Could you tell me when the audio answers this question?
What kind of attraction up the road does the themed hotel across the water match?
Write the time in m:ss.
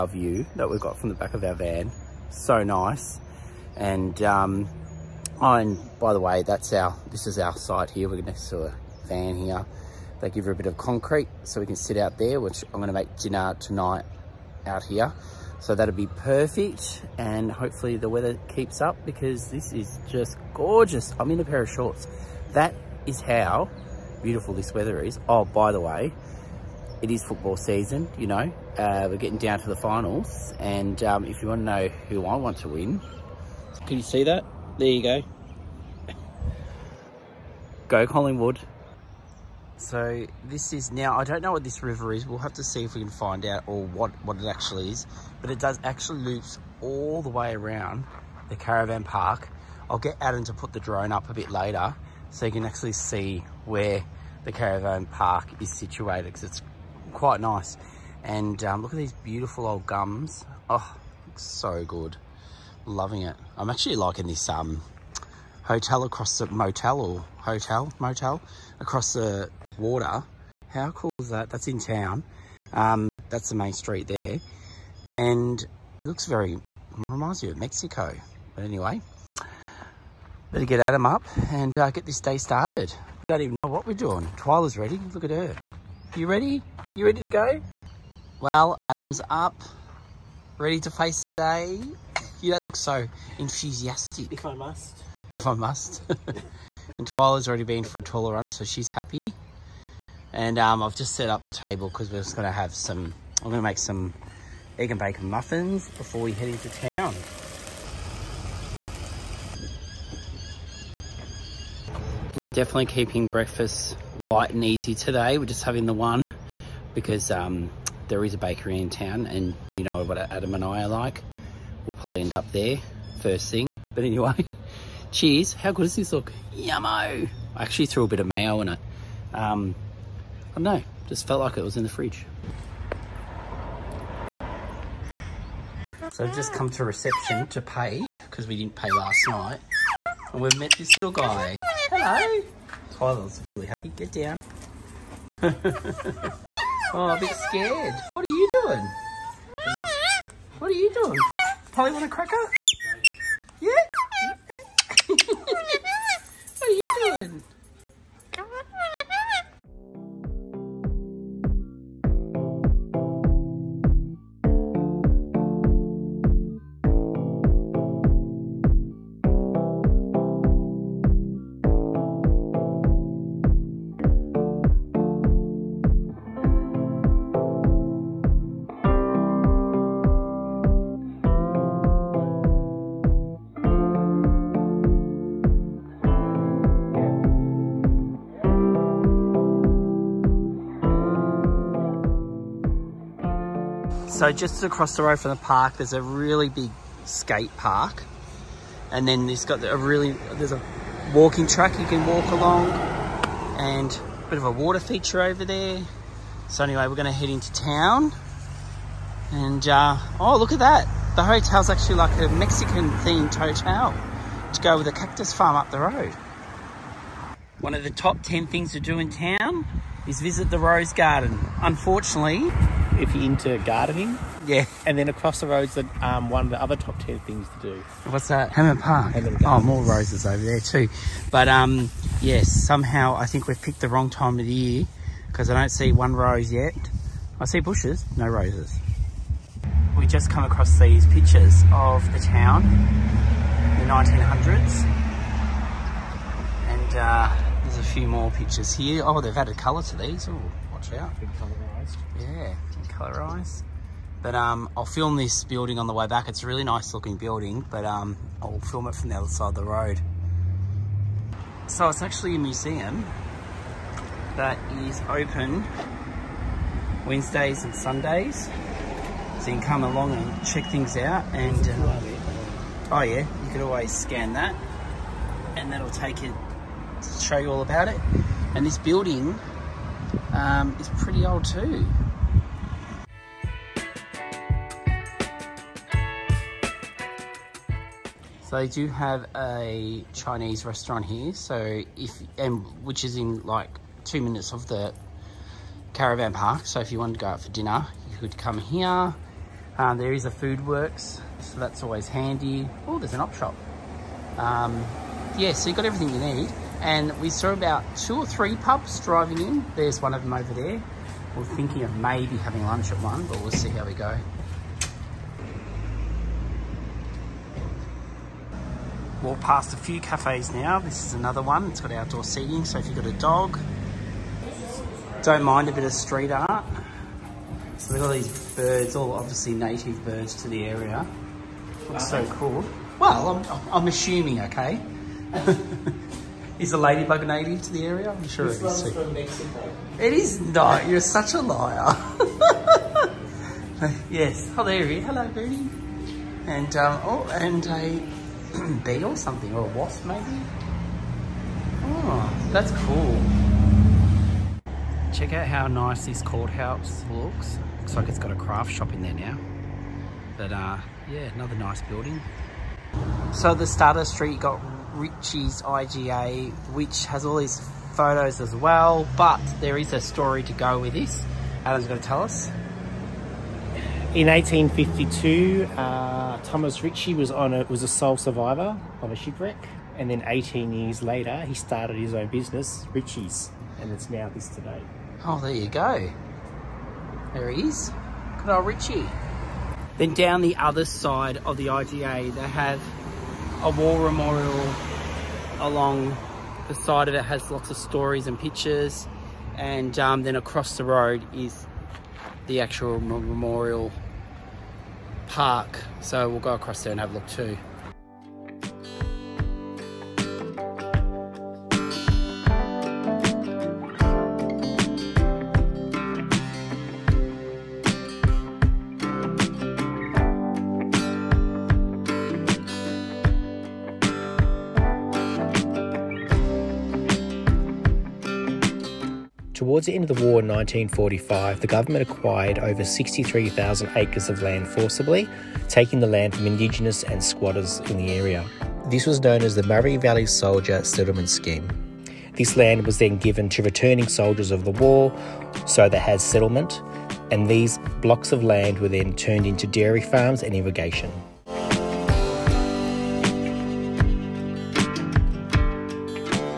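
3:34.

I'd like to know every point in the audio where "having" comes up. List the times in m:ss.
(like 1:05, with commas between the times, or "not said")
1:55, 5:12.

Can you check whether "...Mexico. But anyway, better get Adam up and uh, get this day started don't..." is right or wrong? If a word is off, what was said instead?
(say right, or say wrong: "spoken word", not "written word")
right.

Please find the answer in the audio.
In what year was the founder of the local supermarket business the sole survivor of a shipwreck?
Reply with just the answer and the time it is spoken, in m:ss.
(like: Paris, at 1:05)
1852, at 6:14.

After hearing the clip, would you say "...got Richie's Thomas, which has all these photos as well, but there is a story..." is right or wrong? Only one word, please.
wrong.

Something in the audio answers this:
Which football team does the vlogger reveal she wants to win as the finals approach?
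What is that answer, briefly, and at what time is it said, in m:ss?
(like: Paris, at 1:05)
Collingwood, at 0:38.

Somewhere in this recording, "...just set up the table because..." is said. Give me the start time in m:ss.
1:40.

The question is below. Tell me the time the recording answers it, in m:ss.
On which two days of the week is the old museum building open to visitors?
4:27.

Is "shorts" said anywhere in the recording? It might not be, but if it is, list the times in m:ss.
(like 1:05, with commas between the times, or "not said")
0:21.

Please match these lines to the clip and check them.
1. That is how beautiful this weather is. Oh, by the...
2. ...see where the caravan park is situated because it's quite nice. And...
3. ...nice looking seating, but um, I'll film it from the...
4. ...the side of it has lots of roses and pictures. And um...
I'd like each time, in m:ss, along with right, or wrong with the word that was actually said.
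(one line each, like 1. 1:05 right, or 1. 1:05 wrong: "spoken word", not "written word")
1. 0:22 right
2. 0:52 right
3. 4:16 wrong: "building", not "seating"
4. 6:36 wrong: "stories", not "roses".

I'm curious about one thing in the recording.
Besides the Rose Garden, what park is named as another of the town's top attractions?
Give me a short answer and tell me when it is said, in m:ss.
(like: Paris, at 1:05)
Hammond Park, at 3:48.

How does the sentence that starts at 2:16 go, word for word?
So I've just come to reception to pay because we didn't pay last night.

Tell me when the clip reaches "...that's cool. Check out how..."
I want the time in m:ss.
5:52.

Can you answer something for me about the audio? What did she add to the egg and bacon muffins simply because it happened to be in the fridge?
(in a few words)
Mayo.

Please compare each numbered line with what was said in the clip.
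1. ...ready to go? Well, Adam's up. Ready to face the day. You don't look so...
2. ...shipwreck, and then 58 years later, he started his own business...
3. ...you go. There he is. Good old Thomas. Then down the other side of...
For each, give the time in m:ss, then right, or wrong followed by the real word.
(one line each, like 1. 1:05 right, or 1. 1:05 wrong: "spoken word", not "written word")
1. 1:27 right
2. 6:19 wrong: "18", not "58"
3. 6:25 wrong: "Ritchie", not "Thomas".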